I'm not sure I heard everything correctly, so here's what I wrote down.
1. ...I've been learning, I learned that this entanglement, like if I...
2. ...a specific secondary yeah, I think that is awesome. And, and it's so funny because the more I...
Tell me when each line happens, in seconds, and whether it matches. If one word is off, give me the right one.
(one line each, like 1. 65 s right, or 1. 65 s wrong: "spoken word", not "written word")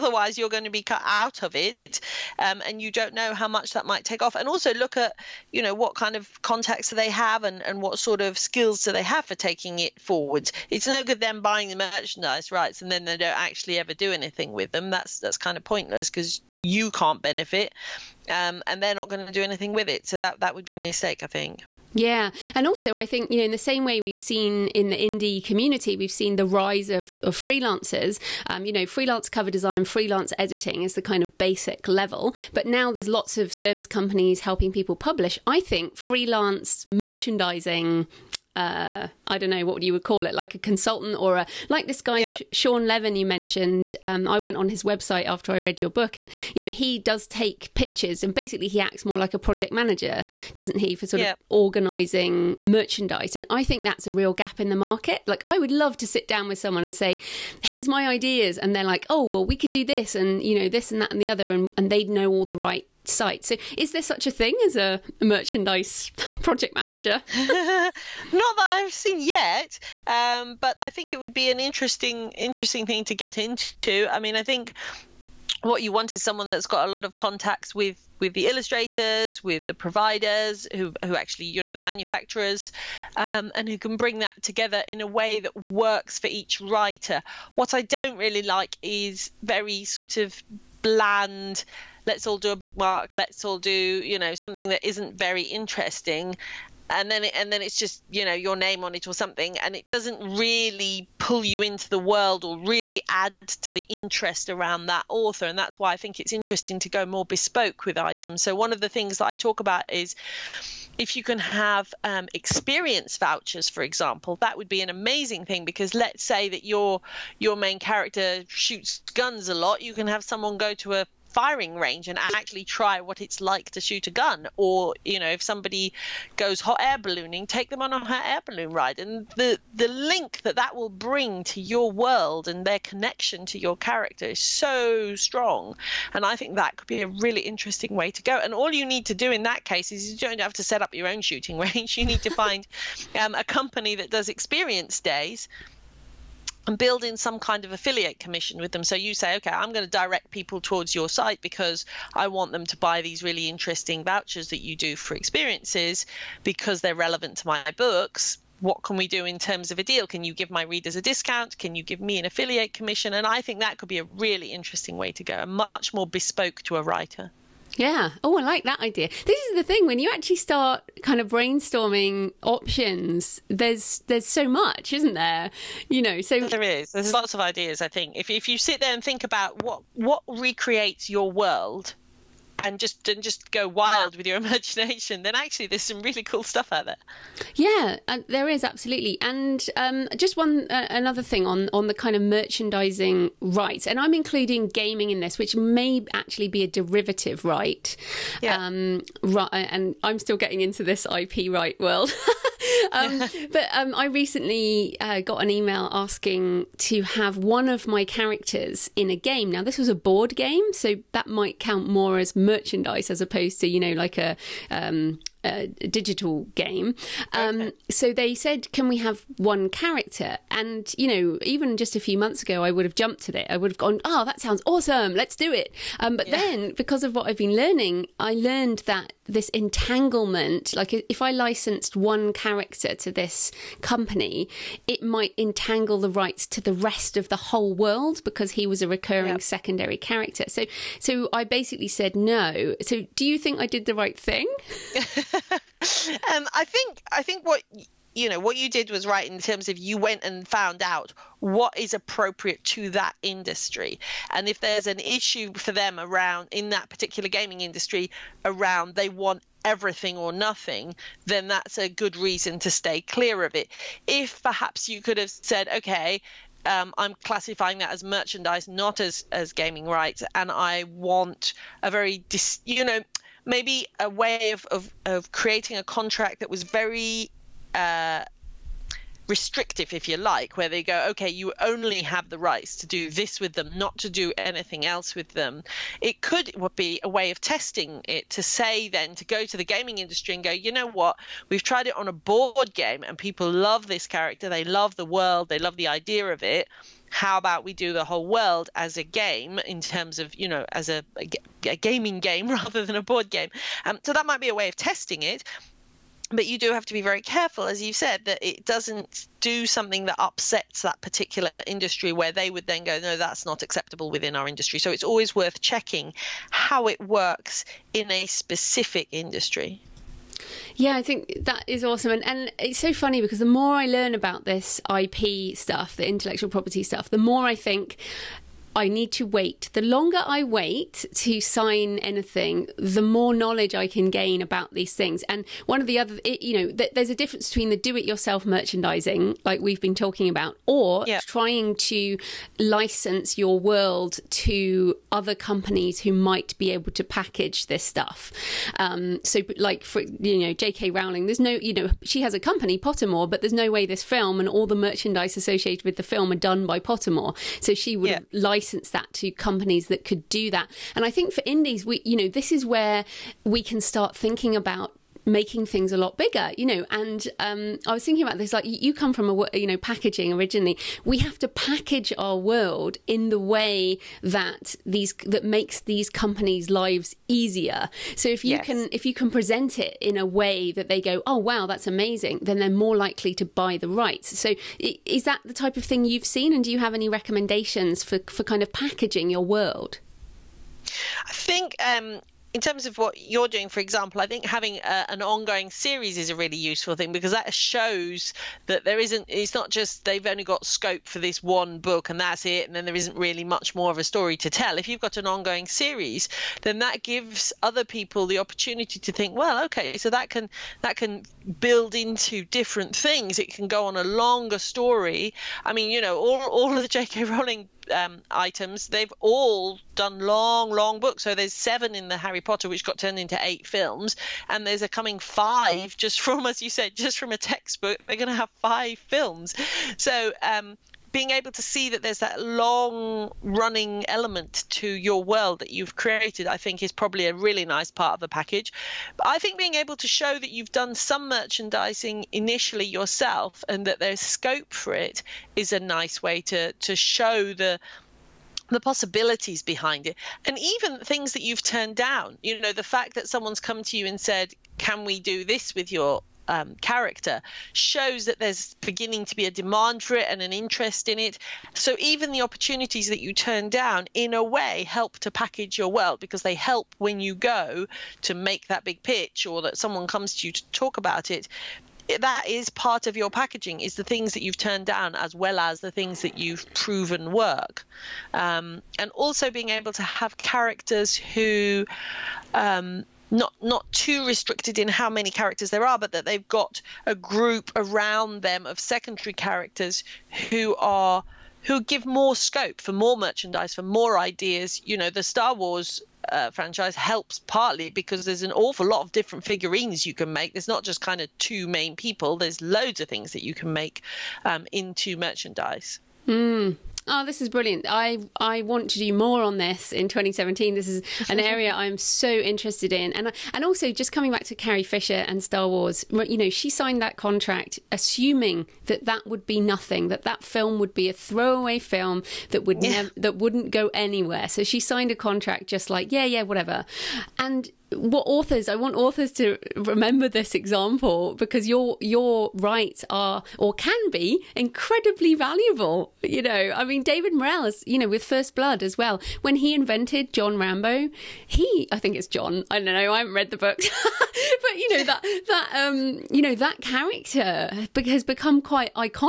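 1. 227 s right
2. 318 s wrong: "industry", not "secondary".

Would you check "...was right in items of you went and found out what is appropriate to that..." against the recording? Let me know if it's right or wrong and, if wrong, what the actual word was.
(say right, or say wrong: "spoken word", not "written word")
wrong: "terms", not "items".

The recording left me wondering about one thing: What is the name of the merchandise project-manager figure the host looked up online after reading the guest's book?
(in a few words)
Sean Levin.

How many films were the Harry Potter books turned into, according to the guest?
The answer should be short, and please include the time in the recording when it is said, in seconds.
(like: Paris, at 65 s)
8, at 423 s.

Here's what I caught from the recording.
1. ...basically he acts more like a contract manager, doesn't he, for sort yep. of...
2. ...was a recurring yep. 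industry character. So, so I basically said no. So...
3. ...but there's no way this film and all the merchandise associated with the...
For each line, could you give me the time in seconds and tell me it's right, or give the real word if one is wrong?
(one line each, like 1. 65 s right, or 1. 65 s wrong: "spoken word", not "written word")
1. 48 s wrong: "project", not "contract"
2. 238 s wrong: "secondary", not "industry"
3. 353 s right.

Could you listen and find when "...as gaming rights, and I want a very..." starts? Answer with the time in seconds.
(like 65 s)
269 s.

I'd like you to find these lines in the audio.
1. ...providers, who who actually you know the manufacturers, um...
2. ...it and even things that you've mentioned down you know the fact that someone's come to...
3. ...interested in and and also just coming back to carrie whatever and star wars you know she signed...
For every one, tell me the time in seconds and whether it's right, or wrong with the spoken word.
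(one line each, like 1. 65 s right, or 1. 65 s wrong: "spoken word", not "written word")
1. 79 s right
2. 450 s wrong: "turned", not "mentioned"
3. 512 s wrong: "fisher", not "whatever".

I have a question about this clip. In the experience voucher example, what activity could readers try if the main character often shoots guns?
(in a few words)
firing range.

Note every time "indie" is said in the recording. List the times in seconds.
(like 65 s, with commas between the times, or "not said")
24 s, 361 s.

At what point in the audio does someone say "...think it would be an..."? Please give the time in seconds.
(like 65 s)
70 s.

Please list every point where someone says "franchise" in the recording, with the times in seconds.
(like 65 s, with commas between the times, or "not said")
496 s.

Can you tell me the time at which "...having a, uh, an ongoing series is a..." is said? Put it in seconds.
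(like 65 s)
394 s.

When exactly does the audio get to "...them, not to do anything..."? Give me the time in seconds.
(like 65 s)
283 s.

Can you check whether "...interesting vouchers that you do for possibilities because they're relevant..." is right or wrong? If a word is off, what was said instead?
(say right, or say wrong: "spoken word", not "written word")
wrong: "experiences", not "possibilities".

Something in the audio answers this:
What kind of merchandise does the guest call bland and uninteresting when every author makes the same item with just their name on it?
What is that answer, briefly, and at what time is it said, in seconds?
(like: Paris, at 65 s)
a bookmark, at 92 s.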